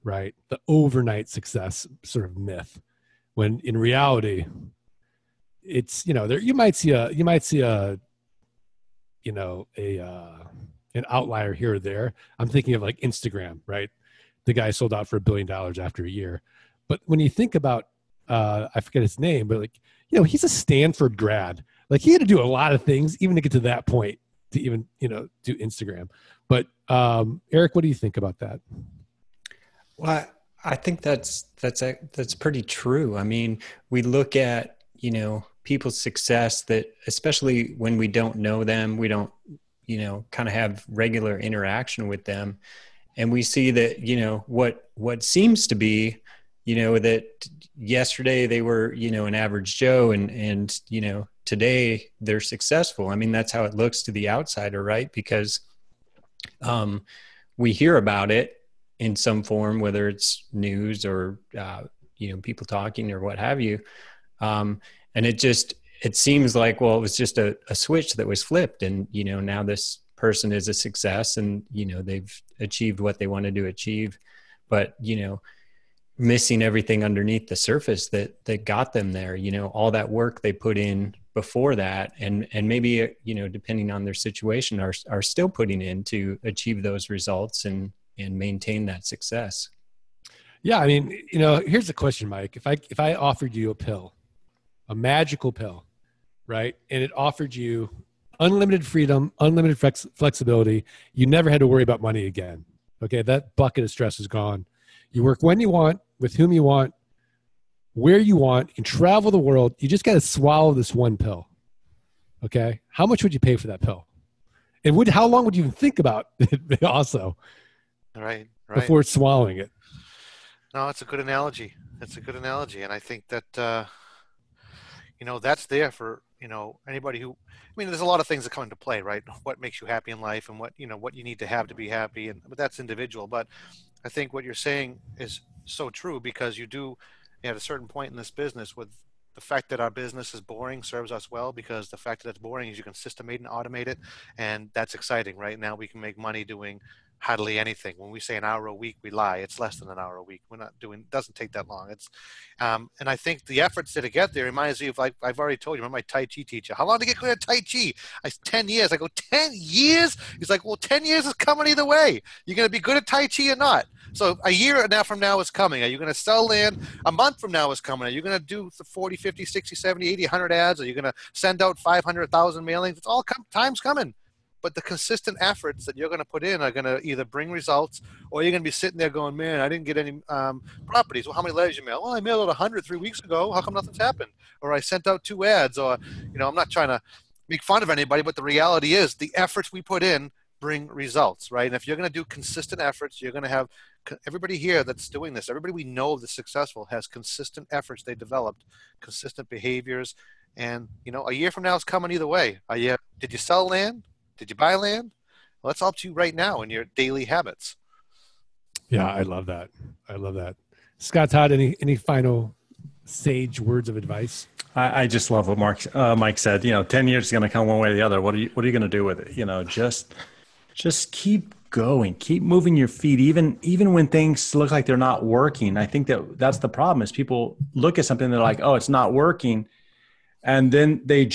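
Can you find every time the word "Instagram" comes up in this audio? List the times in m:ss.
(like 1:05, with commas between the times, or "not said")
0:12, 0:25.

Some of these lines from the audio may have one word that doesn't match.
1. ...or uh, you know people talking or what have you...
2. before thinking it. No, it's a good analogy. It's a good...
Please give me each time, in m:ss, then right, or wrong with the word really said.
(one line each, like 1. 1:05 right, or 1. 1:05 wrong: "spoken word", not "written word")
1. 1:01 right
2. 1:58 wrong: "swallowing", not "thinking".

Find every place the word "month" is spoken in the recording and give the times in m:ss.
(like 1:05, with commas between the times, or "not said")
2:47.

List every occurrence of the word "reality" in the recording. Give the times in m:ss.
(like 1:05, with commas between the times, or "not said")
0:03, 3:08.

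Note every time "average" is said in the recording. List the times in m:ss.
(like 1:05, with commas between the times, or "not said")
0:49.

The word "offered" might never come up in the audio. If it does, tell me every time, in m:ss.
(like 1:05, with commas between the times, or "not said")
1:33, 1:37.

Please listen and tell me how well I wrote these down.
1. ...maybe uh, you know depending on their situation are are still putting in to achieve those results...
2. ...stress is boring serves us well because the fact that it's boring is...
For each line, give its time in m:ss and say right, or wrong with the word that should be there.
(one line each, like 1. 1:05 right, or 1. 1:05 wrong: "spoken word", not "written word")
1. 1:22 right
2. 2:19 wrong: "business", not "stress".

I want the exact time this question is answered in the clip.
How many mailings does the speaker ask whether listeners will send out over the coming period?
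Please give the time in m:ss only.
2:51.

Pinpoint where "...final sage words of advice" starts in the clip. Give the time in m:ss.
3:31.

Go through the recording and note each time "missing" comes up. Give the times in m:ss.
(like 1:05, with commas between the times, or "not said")
1:16.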